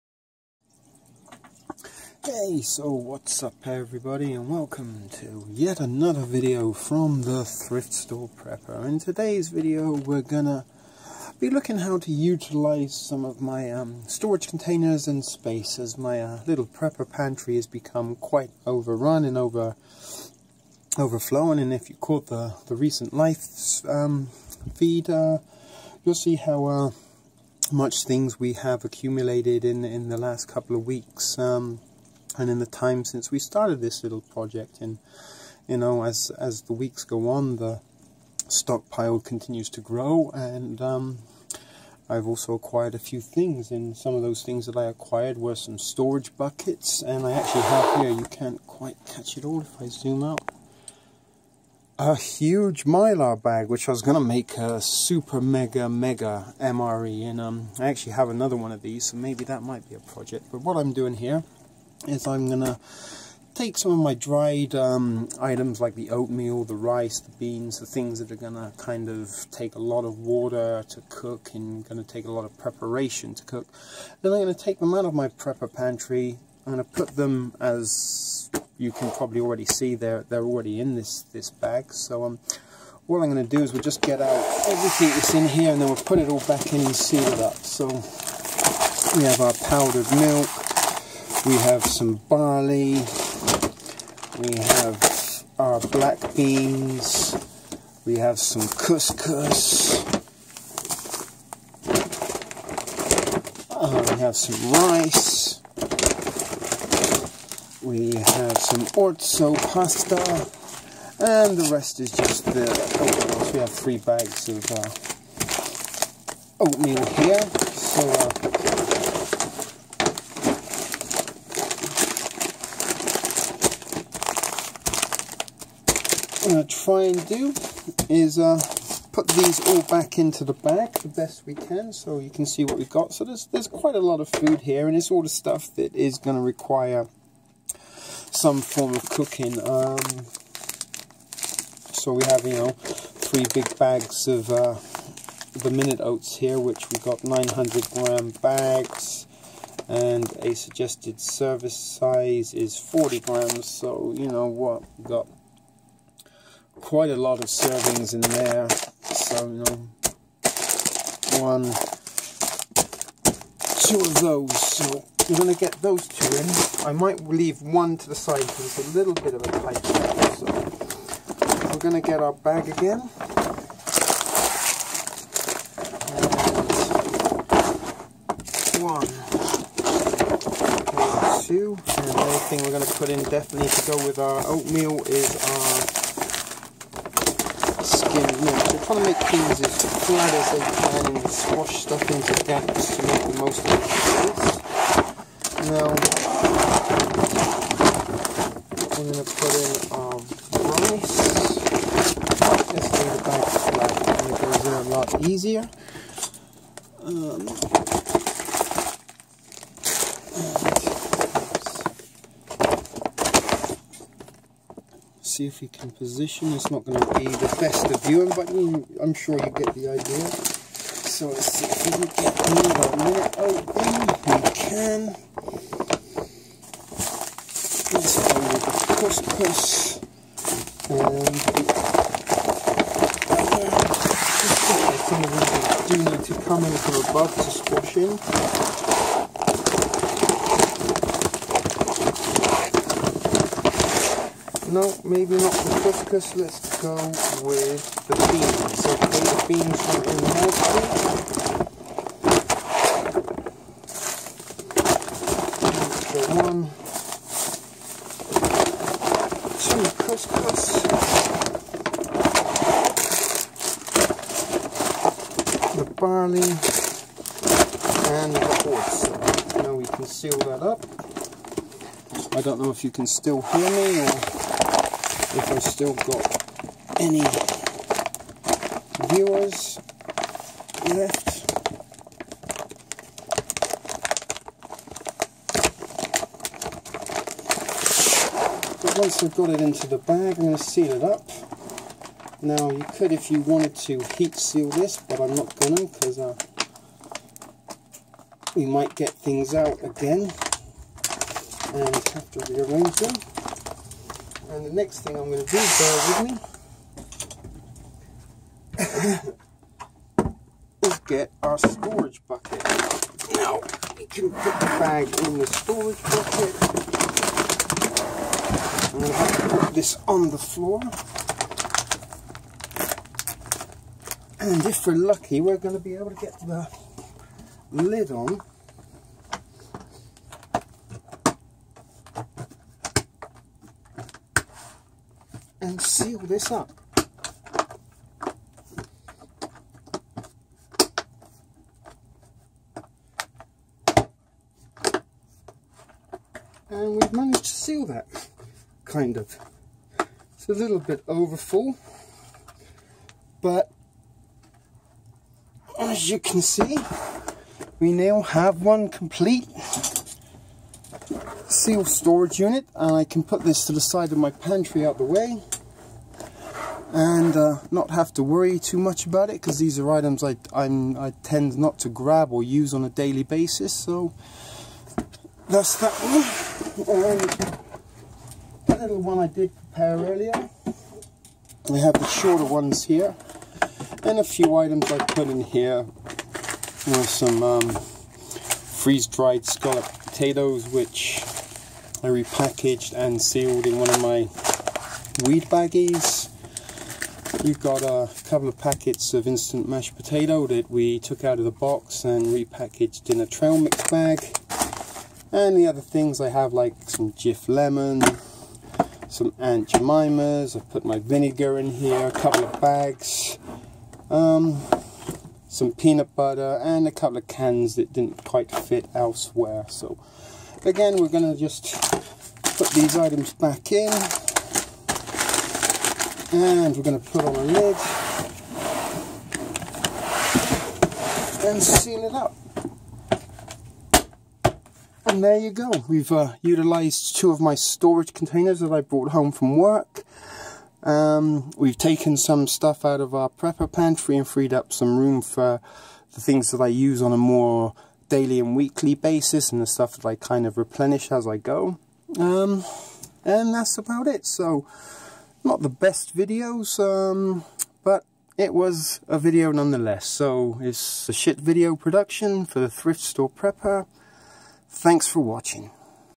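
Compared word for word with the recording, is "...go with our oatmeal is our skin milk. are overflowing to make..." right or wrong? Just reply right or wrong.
wrong.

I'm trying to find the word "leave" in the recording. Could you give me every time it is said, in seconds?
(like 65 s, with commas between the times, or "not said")
167 s, 202 s.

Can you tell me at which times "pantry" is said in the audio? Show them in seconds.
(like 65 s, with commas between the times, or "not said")
17 s, 75 s, 364 s, 443 s.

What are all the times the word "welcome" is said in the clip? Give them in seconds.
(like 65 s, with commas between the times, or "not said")
4 s.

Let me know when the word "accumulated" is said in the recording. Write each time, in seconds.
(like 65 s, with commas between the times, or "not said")
28 s.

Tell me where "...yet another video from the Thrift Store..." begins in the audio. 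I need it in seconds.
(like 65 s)
5 s.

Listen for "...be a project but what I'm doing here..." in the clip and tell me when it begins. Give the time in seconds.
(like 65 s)
59 s.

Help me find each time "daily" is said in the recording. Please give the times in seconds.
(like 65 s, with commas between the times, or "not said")
372 s, 448 s.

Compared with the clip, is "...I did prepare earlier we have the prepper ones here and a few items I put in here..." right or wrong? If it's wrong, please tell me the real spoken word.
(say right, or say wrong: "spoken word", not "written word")
wrong: "shorter", not "prepper".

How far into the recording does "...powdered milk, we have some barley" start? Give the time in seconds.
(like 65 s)
89 s.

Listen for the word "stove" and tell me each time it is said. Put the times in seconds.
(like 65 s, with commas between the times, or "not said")
not said.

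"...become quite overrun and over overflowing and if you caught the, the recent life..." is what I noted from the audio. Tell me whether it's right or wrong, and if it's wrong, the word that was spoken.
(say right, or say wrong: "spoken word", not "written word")
right.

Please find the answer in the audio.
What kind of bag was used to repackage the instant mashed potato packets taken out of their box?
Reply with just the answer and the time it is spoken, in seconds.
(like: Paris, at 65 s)
trail mix bag, at 403 s.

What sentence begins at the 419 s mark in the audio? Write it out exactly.
So Again, we're going to just put these items back in.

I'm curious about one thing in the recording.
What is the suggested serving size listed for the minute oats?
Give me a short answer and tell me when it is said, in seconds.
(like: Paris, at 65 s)
40 grams, at 152 s.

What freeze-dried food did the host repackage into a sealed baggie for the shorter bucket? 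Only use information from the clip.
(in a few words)
scallop potatoes.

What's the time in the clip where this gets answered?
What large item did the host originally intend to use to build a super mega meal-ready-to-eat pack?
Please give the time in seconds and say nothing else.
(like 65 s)
52 s.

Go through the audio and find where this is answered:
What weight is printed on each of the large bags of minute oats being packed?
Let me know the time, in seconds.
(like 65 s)
147 s.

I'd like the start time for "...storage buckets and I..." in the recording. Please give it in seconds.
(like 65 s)
45 s.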